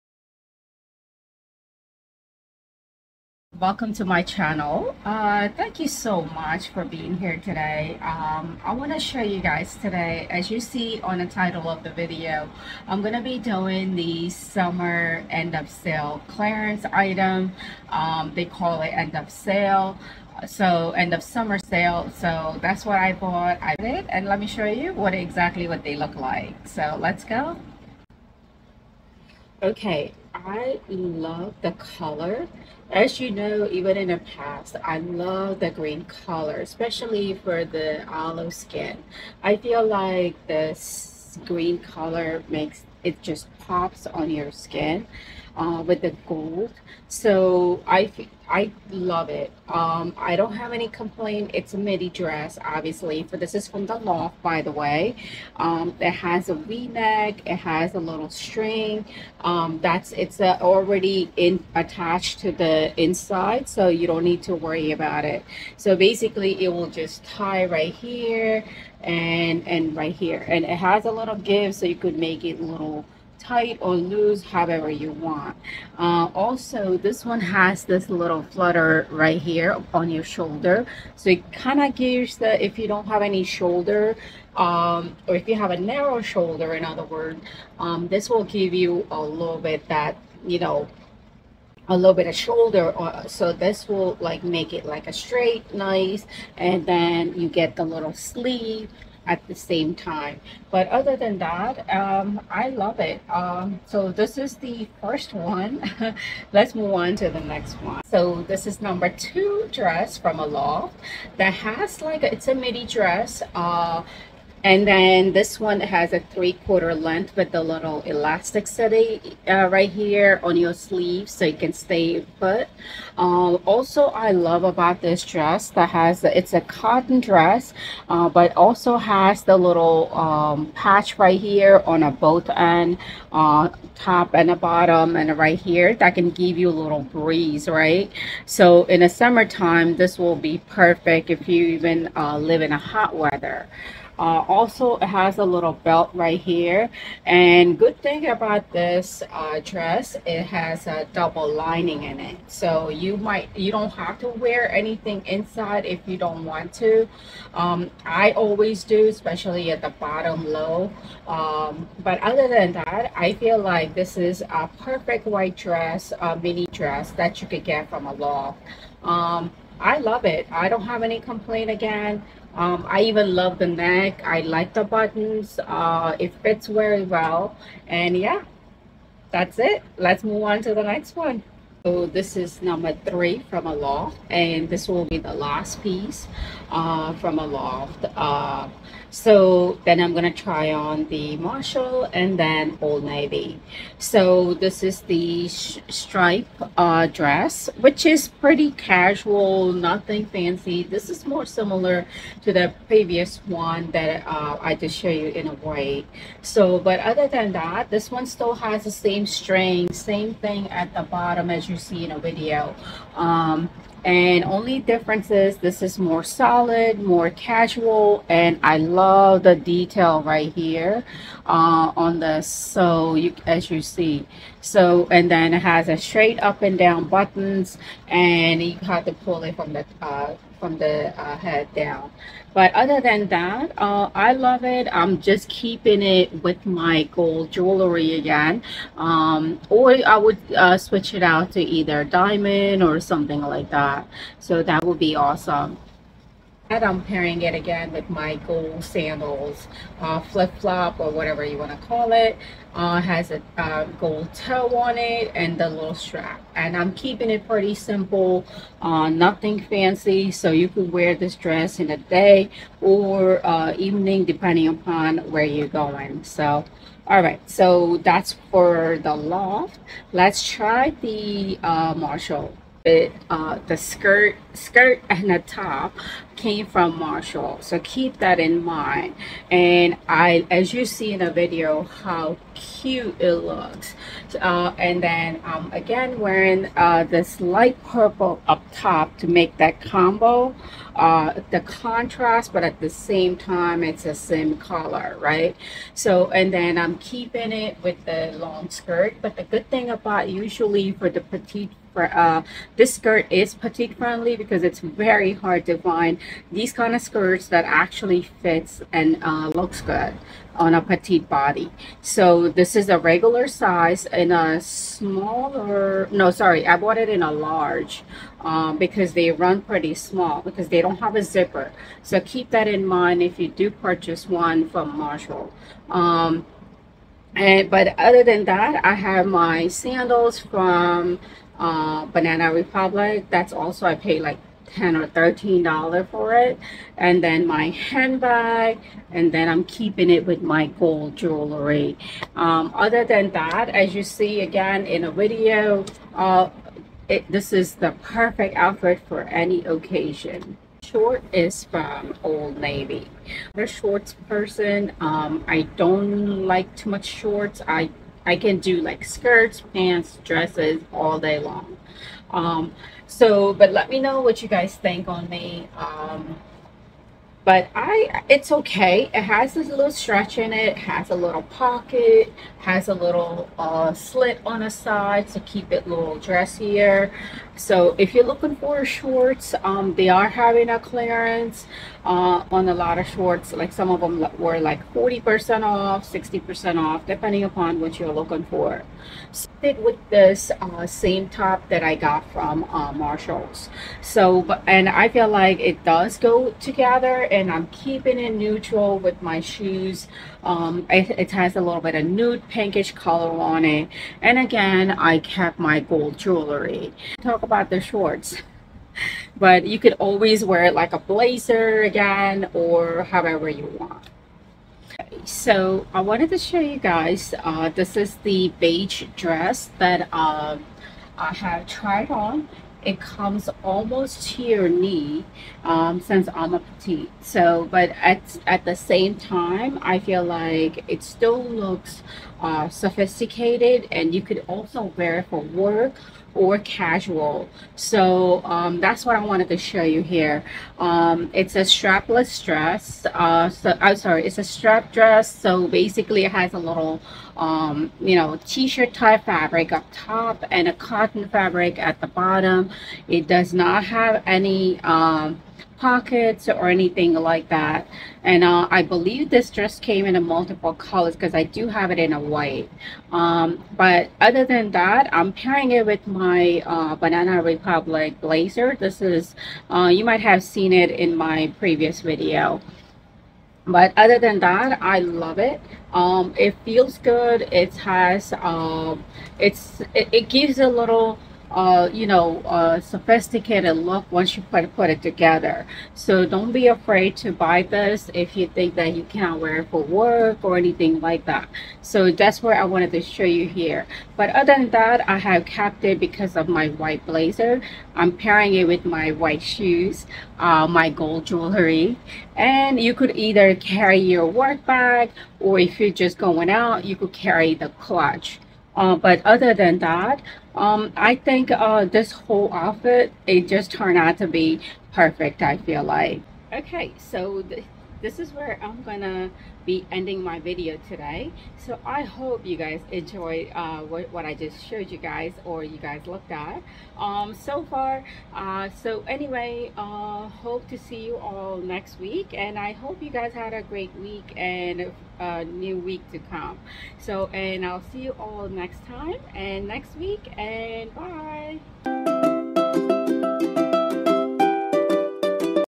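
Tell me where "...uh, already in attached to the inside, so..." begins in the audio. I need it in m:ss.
1:00.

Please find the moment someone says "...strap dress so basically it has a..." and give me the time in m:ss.
7:24.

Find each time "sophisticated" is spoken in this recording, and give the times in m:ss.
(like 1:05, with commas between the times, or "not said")
7:12, 8:02.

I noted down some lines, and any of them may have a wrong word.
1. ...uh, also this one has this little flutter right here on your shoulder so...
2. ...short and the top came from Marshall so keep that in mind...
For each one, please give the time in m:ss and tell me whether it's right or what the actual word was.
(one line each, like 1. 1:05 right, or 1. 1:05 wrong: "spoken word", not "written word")
1. 1:15 right
2. 4:34 wrong: "skirt", not "short".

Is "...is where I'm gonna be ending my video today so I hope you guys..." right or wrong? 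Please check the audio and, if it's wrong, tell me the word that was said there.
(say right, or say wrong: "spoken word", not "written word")
right.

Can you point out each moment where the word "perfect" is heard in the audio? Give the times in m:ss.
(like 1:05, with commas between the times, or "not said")
2:20, 2:44, 5:48, 8:34.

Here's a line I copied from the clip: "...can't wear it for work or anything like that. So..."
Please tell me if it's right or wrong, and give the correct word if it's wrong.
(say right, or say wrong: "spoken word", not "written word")
right.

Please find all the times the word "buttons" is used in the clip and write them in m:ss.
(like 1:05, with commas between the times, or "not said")
2:54, 3:47.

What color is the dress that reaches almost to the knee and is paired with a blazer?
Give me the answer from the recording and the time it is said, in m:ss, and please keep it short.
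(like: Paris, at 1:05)
Beige, at 6:58.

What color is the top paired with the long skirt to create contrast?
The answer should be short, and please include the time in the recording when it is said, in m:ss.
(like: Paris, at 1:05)
Light purple, at 4:47.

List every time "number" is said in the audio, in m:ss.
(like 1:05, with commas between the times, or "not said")
1:48, 3:02.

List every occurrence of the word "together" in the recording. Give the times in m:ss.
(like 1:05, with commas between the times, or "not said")
6:36, 8:05.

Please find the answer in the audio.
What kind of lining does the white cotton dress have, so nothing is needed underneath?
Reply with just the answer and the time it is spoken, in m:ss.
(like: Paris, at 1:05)
Double lining, at 2:31.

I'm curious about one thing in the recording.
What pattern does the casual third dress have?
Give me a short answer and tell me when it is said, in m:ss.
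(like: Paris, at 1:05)
Stripe, at 3:15.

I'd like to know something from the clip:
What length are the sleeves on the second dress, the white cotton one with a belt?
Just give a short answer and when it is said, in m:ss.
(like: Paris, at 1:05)
Three quarter, at 1:56.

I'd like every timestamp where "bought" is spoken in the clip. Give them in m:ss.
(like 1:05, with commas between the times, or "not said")
0:23, 5:16.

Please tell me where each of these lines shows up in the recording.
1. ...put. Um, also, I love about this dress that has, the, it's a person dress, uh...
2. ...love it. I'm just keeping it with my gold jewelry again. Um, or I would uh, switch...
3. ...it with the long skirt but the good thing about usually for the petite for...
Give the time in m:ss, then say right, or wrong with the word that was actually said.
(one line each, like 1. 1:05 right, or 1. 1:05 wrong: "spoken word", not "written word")
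1. 2:02 wrong: "cotton", not "person"
2. 3:54 right
3. 4:57 right.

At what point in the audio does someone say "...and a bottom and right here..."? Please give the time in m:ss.
2:14.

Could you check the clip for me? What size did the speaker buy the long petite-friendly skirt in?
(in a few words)
Large.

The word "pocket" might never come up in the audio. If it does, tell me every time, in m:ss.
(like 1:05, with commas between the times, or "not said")
6:11, 7:35.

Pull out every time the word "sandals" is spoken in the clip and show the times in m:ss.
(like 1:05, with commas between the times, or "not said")
4:08, 5:29.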